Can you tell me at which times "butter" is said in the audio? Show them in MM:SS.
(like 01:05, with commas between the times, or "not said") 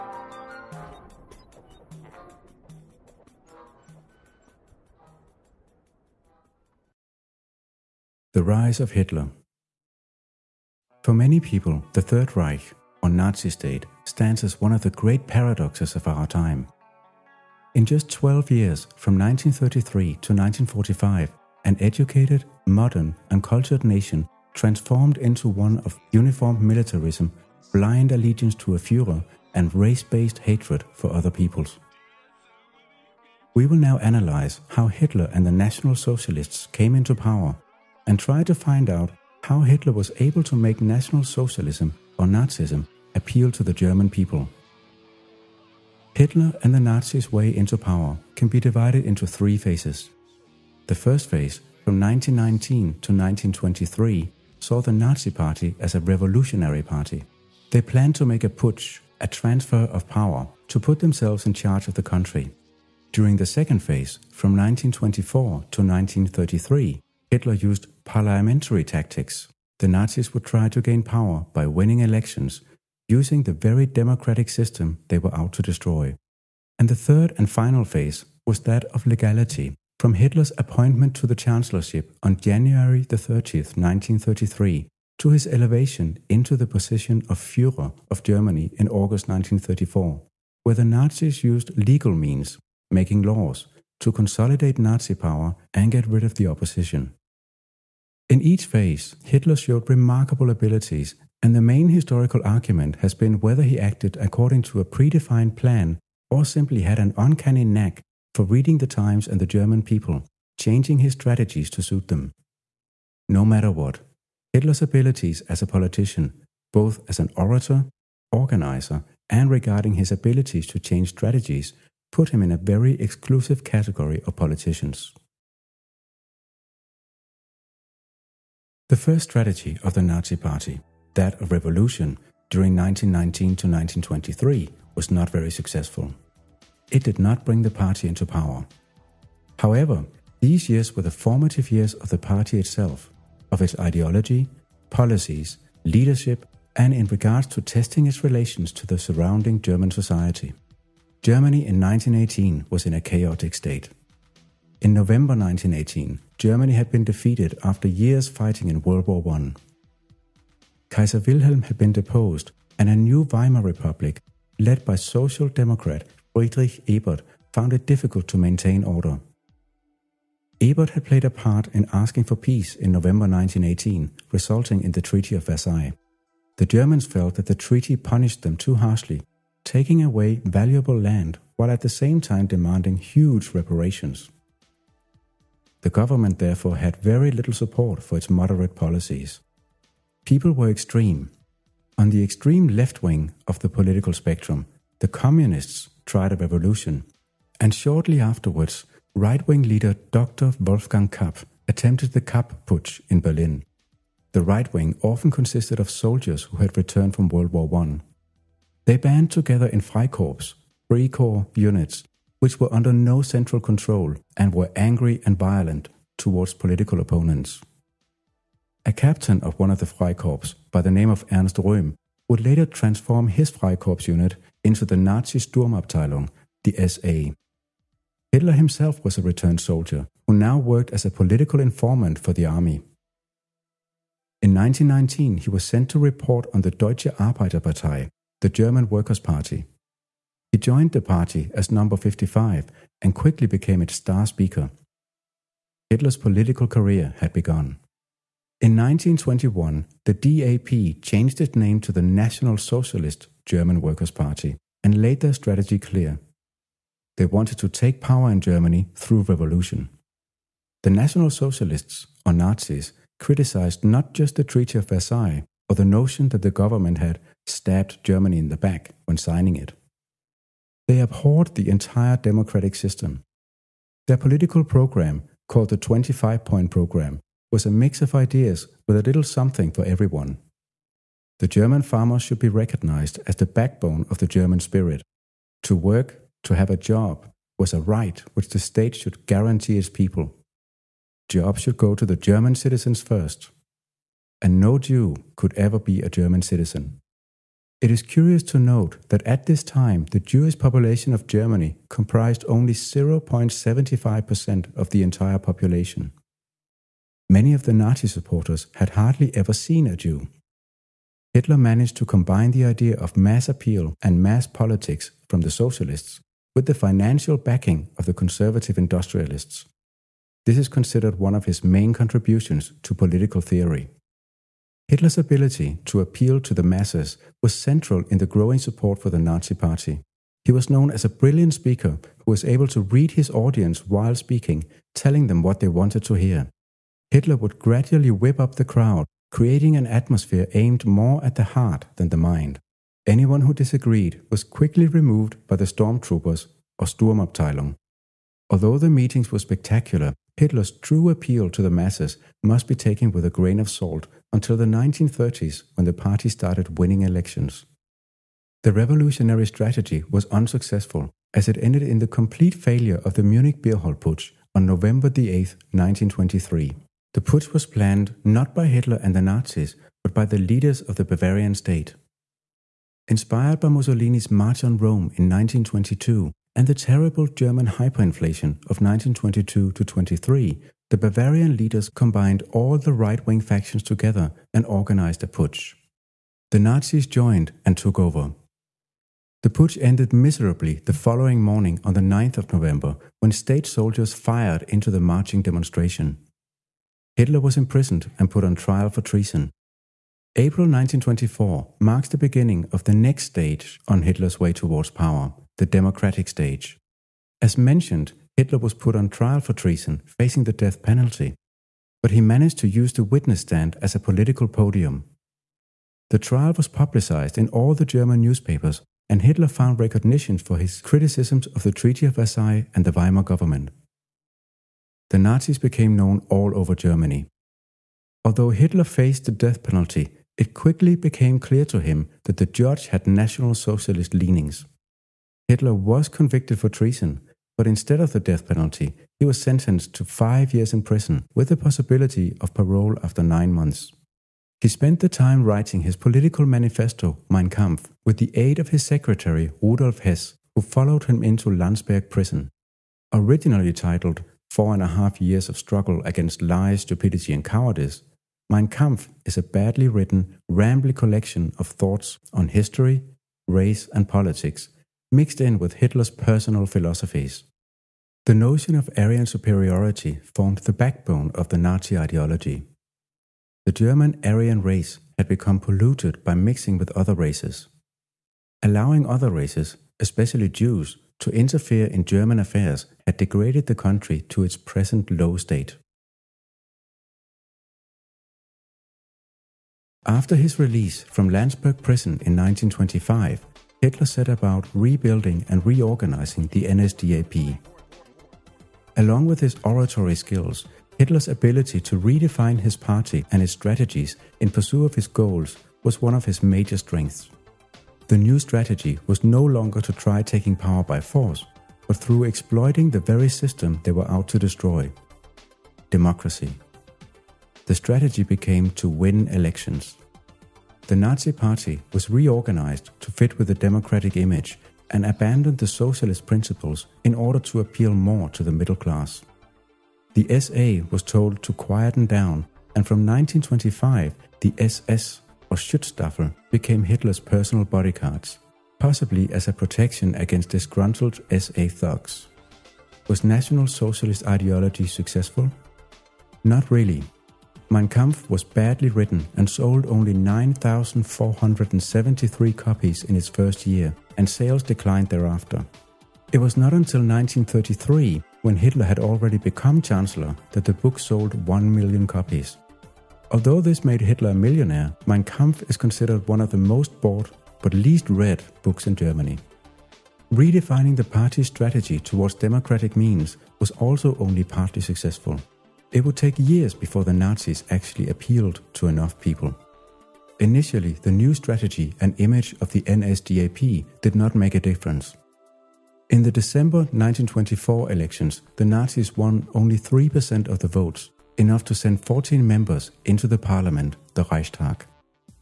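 not said.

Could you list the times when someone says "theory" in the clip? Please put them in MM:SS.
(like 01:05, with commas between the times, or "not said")
05:23.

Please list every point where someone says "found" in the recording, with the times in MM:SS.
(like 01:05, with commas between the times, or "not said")
02:47, 06:59.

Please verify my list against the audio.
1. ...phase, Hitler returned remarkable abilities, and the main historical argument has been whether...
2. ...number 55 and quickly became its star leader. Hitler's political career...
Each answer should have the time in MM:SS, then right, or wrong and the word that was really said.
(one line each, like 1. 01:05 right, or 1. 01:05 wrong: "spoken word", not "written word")
1. 01:38 wrong: "showed", not "returned"
2. 04:01 wrong: "speaker", not "leader".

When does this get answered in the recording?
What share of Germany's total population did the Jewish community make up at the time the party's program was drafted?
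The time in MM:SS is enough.
05:02.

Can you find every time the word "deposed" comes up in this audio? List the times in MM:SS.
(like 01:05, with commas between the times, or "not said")
02:41.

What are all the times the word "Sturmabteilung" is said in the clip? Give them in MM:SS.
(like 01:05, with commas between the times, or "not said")
03:45, 05:46.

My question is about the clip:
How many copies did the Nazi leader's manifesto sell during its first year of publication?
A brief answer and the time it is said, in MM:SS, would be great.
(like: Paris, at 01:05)
9,473, at 09:10.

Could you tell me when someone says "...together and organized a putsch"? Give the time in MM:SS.
06:23.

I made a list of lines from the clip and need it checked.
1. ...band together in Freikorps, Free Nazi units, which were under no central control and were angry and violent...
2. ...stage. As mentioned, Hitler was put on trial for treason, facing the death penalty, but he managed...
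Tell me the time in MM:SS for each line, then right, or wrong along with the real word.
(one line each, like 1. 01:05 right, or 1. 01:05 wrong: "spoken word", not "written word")
1. 03:28 wrong: "Corps", not "Nazi"
2. 06:46 right.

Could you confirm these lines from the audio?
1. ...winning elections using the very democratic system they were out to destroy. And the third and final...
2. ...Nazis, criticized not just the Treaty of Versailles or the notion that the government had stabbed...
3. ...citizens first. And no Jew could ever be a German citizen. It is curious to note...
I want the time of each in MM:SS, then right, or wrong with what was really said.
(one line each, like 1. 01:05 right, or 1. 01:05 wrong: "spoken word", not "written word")
1. 01:11 right
2. 04:22 right
3. 04:52 right.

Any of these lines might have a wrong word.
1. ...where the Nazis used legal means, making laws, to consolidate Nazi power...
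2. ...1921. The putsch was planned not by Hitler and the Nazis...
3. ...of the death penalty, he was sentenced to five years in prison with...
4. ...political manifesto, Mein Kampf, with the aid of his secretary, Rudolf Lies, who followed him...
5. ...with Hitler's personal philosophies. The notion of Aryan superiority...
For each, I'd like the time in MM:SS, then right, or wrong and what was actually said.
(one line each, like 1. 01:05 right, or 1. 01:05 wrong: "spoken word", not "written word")
1. 01:30 right
2. 06:05 wrong: "1923", not "1921"
3. 07:18 right
4. 07:25 wrong: "Hess", not "Lies"
5. 07:45 right.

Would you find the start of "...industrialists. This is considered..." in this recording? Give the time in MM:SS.
05:18.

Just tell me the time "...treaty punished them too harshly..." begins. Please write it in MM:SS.
02:57.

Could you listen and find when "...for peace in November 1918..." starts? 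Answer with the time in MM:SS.
02:52.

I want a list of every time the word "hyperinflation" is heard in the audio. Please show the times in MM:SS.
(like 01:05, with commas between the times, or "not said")
06:17.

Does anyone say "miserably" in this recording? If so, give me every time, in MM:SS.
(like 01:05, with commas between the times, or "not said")
06:30.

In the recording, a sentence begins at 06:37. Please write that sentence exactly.
Hitler was imprisoned and put on trial for treason.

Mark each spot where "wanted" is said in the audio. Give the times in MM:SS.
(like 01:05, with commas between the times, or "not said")
04:17, 05:35.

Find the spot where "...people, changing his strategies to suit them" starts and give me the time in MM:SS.
01:49.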